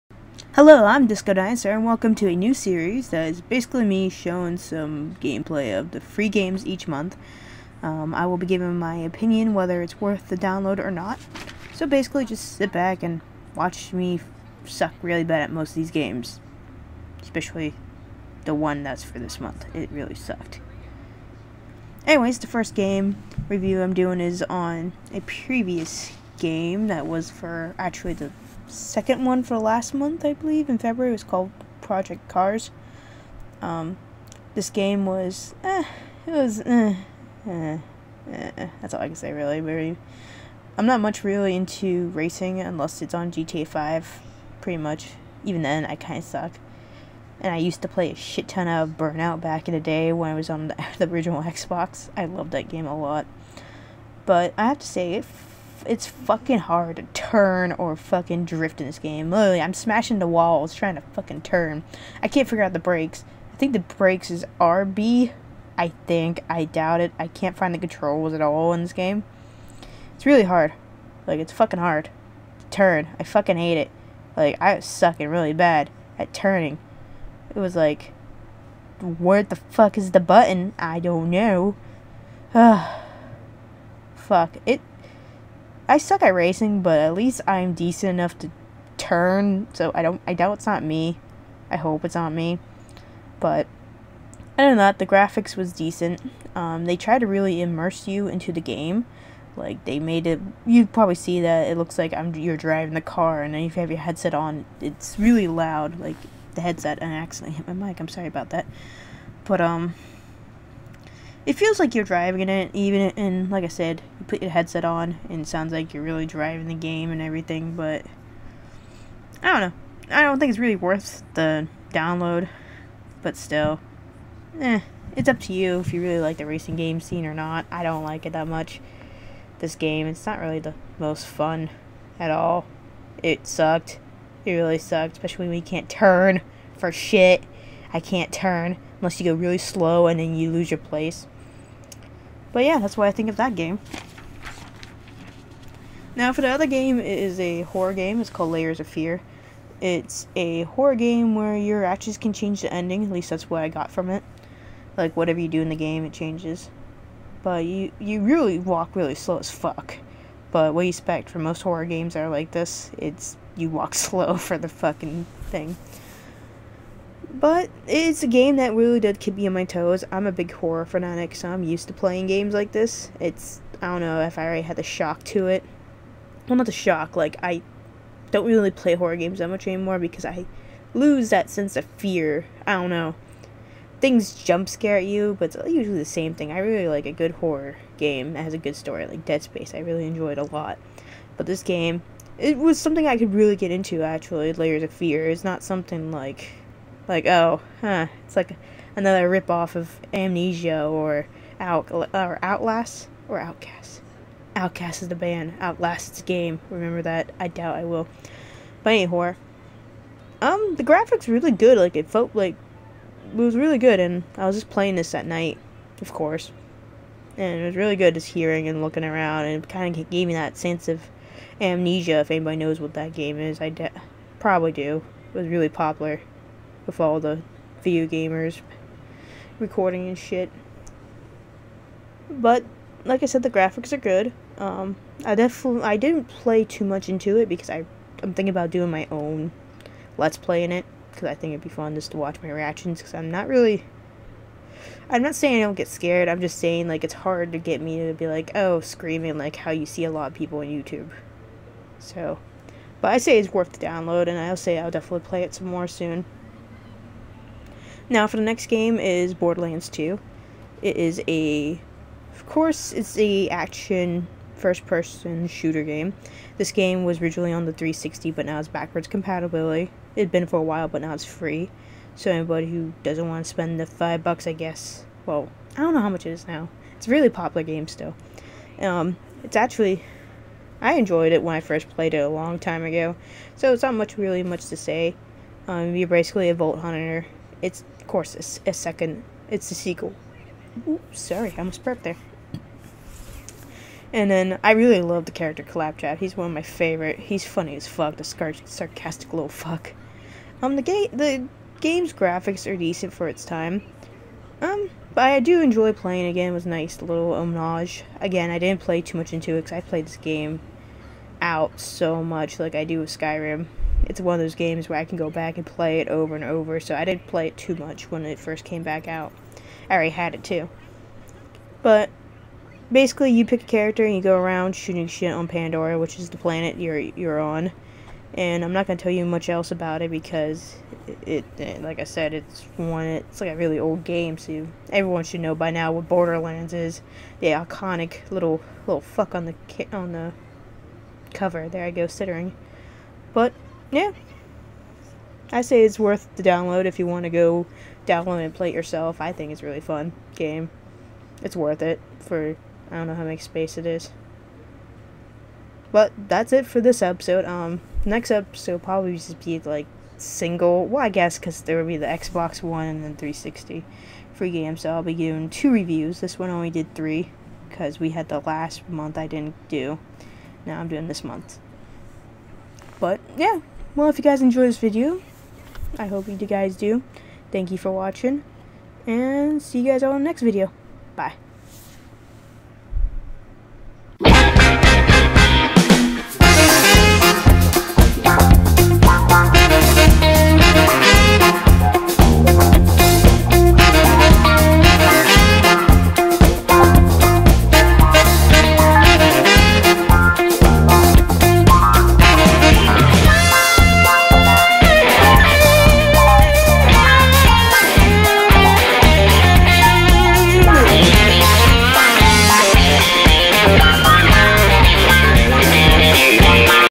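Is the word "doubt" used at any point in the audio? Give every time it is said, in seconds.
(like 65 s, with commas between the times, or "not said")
66 s, 90 s, 207 s.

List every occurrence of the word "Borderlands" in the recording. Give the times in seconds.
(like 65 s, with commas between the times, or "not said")
259 s, 336 s.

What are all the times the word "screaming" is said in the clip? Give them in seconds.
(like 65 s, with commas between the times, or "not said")
248 s.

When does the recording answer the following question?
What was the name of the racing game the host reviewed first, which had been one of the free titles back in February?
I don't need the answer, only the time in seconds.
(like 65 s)
31 s.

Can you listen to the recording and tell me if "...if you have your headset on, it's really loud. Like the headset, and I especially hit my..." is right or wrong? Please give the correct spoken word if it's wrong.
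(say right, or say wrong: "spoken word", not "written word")
wrong: "accidentally", not "especially".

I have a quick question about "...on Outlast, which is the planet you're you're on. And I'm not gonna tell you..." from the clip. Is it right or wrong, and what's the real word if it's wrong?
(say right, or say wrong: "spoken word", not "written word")
wrong: "Pandora", not "Outlast".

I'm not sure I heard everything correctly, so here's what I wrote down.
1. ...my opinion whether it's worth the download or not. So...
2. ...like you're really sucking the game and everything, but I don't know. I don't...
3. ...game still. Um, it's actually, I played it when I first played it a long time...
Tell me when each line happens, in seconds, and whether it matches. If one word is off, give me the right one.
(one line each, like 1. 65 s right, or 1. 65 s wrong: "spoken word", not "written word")
1. 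8 s right
2. 115 s wrong: "driving", not "sucking"
3. 277 s wrong: "enjoyed", not "played".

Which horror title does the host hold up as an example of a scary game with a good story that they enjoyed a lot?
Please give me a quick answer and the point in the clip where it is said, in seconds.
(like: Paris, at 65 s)
Dead Space, at 189 s.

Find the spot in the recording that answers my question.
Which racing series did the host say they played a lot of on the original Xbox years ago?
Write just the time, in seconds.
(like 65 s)
48 s.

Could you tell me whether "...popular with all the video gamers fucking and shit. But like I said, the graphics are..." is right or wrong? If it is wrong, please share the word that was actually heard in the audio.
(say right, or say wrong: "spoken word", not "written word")
wrong: "recording", not "fucking".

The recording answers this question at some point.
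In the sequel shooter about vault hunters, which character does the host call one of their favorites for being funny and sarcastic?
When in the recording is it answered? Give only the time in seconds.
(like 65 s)
295 s.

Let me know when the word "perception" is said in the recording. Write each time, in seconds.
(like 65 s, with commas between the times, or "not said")
not said.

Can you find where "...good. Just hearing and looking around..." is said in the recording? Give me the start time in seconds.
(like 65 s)
217 s.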